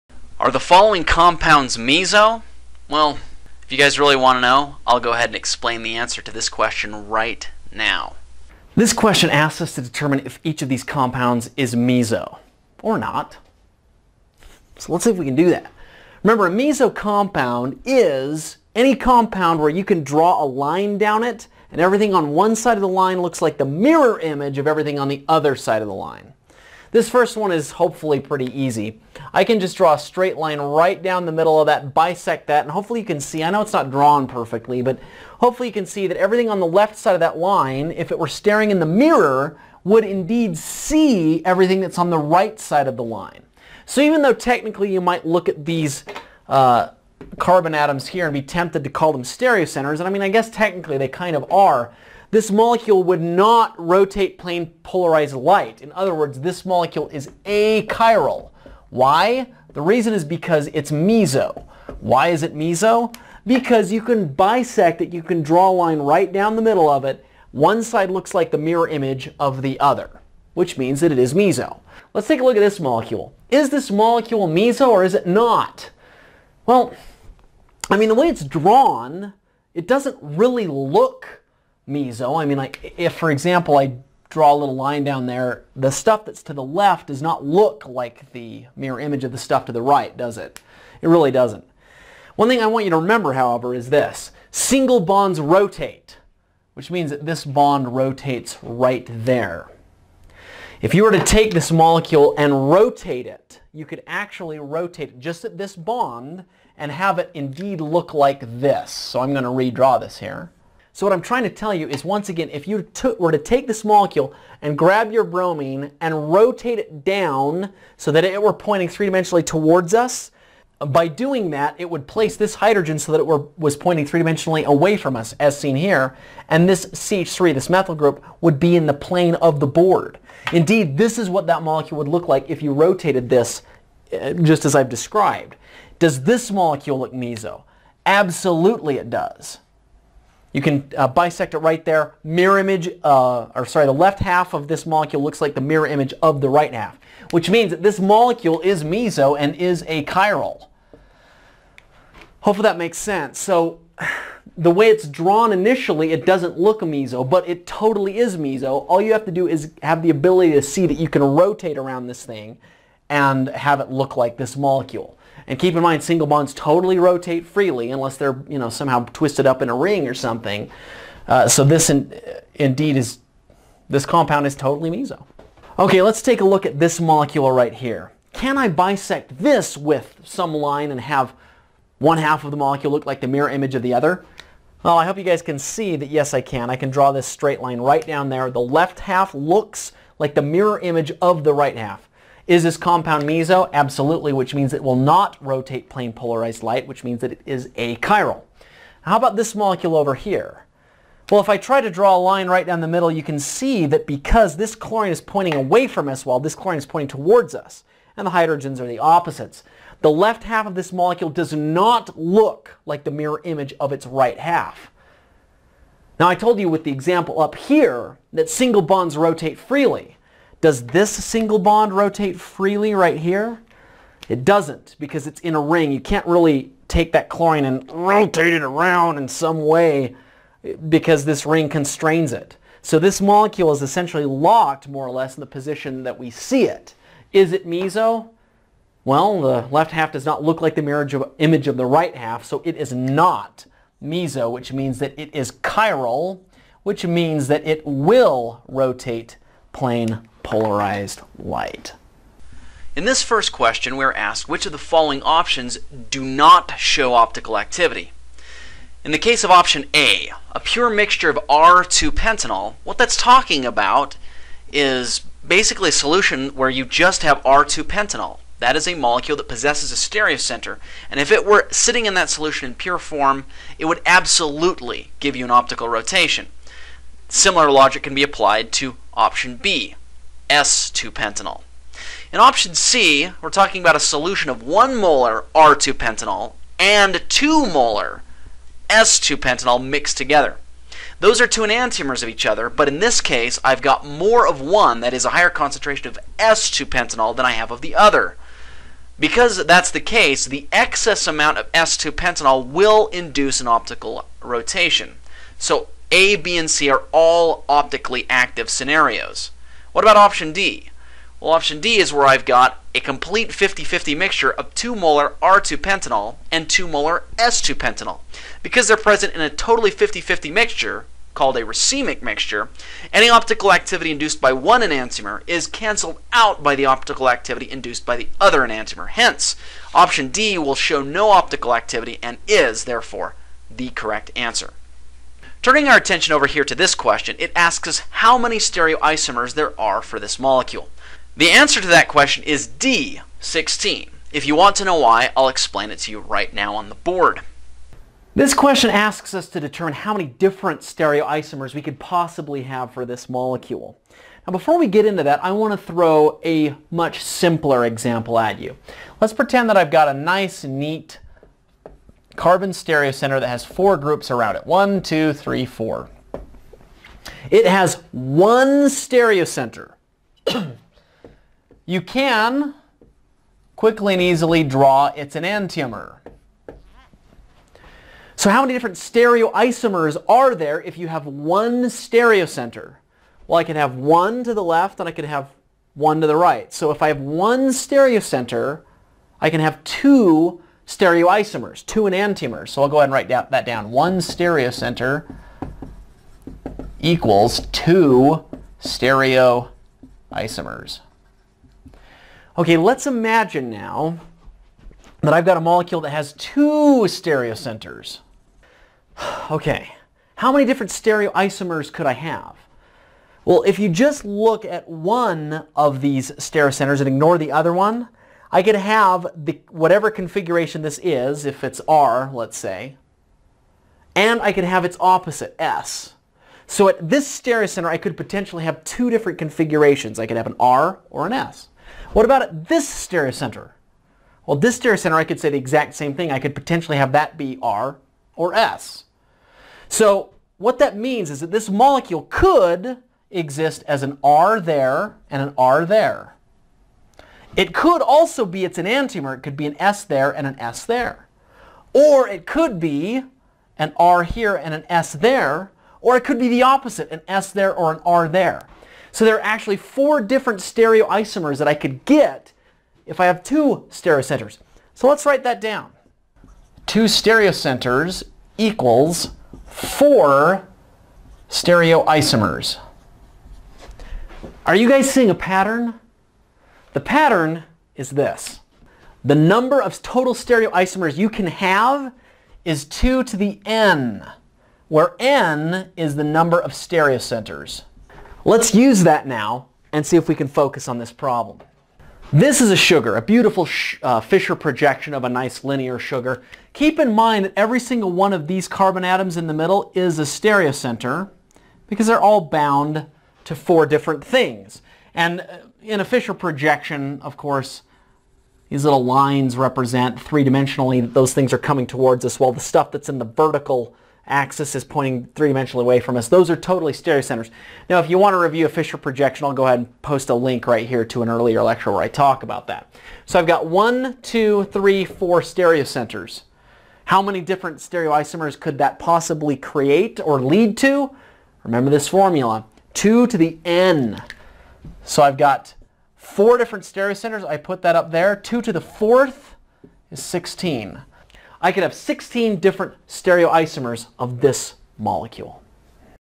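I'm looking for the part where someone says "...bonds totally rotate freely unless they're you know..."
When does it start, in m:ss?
2:46.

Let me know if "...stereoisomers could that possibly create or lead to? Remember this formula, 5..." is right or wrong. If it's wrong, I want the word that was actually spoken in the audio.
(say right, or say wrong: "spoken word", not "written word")
wrong: "2", not "5".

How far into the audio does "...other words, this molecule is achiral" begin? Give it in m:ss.
0:55.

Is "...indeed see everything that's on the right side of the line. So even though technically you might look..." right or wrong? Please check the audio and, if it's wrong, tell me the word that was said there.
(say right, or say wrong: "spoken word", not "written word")
right.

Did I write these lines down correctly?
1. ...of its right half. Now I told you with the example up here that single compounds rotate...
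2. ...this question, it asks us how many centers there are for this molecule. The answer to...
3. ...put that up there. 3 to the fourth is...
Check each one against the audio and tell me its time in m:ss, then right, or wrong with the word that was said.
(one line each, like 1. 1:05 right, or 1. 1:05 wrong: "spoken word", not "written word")
1. 3:33 wrong: "bonds", not "compounds"
2. 5:36 wrong: "stereoisomers", not "centers"
3. 8:57 wrong: "2", not "3".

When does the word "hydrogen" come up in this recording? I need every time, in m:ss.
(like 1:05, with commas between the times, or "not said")
2:02, 3:28.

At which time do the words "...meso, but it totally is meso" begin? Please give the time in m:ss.
2:36.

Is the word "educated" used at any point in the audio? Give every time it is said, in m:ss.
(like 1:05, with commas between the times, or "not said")
not said.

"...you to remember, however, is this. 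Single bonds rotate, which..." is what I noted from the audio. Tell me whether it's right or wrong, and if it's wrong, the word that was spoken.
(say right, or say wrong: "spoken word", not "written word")
right.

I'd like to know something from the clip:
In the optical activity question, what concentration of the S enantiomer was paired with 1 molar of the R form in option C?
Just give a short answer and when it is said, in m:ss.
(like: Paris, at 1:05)
2 molar, at 4:47.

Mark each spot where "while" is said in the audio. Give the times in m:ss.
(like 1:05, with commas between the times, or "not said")
3:26, 8:32.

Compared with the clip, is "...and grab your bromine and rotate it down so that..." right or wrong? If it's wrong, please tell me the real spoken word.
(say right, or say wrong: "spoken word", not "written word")
right.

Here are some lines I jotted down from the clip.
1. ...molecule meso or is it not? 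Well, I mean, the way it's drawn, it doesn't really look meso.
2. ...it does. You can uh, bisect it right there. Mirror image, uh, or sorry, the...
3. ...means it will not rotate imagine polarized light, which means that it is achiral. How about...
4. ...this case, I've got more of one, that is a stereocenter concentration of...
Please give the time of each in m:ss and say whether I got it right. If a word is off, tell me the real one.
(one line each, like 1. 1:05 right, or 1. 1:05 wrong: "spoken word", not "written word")
1. 1:13 right
2. 2:18 right
3. 3:14 wrong: "plane", not "imagine"
4. 4:52 wrong: "higher", not "stereocenter".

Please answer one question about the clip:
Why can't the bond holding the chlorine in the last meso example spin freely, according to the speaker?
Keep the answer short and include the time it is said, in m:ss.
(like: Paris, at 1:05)
It's in a ring, at 3:44.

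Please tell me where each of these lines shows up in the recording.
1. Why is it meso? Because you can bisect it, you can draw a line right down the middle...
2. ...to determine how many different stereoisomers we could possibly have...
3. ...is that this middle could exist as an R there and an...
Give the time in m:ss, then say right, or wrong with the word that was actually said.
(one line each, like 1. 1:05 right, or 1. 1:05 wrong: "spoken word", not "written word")
1. 1:02 right
2. 5:49 right
3. 7:21 wrong: "molecule", not "middle".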